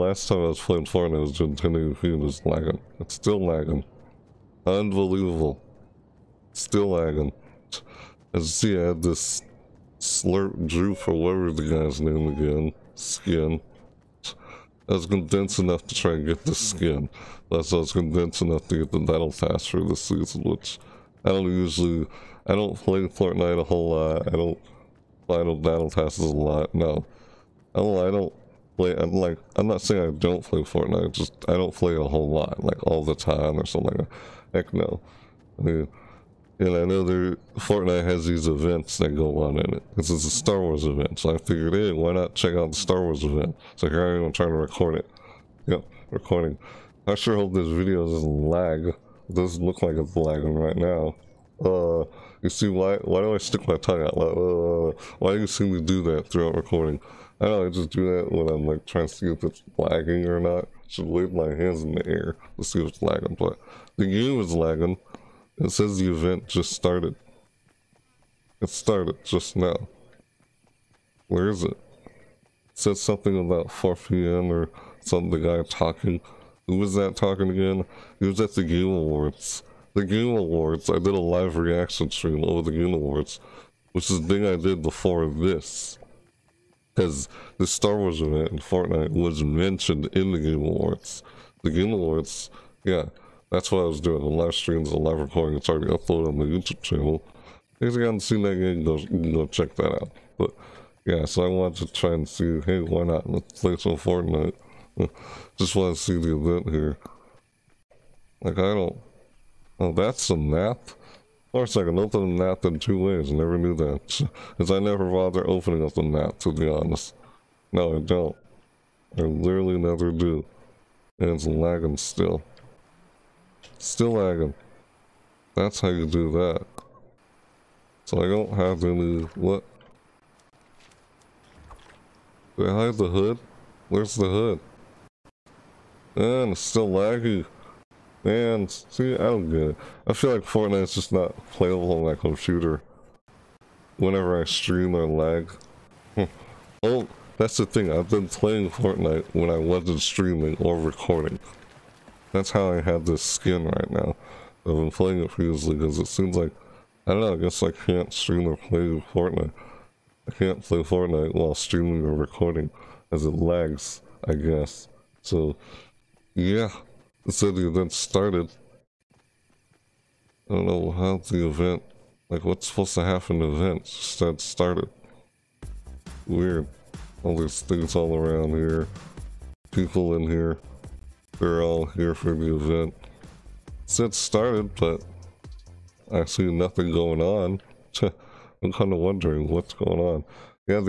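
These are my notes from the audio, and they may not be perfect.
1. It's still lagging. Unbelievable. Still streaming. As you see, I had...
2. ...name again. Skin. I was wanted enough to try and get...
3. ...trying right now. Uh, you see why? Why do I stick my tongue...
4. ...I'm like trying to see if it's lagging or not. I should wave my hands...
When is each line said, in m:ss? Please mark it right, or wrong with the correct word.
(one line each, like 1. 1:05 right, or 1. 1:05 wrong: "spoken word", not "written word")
1. 0:02 wrong: "lagging", not "streaming"
2. 0:11 wrong: "condensed", not "wanted"
3. 0:50 wrong: "lagging", not "trying"
4. 0:58 right.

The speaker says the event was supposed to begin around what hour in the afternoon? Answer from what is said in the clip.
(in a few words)
4 p.m.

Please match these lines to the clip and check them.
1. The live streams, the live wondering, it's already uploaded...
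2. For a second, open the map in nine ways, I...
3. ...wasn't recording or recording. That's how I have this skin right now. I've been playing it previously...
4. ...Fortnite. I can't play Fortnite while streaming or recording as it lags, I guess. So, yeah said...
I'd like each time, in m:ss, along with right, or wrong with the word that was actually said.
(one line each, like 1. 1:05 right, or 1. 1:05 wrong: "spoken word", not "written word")
1. 1:34 wrong: "recording", not "wondering"
2. 1:51 wrong: "two", not "nine"
3. 2:29 wrong: "streaming", not "recording"
4. 2:39 right.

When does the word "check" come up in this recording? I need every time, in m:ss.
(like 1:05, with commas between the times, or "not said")
0:42, 1:39.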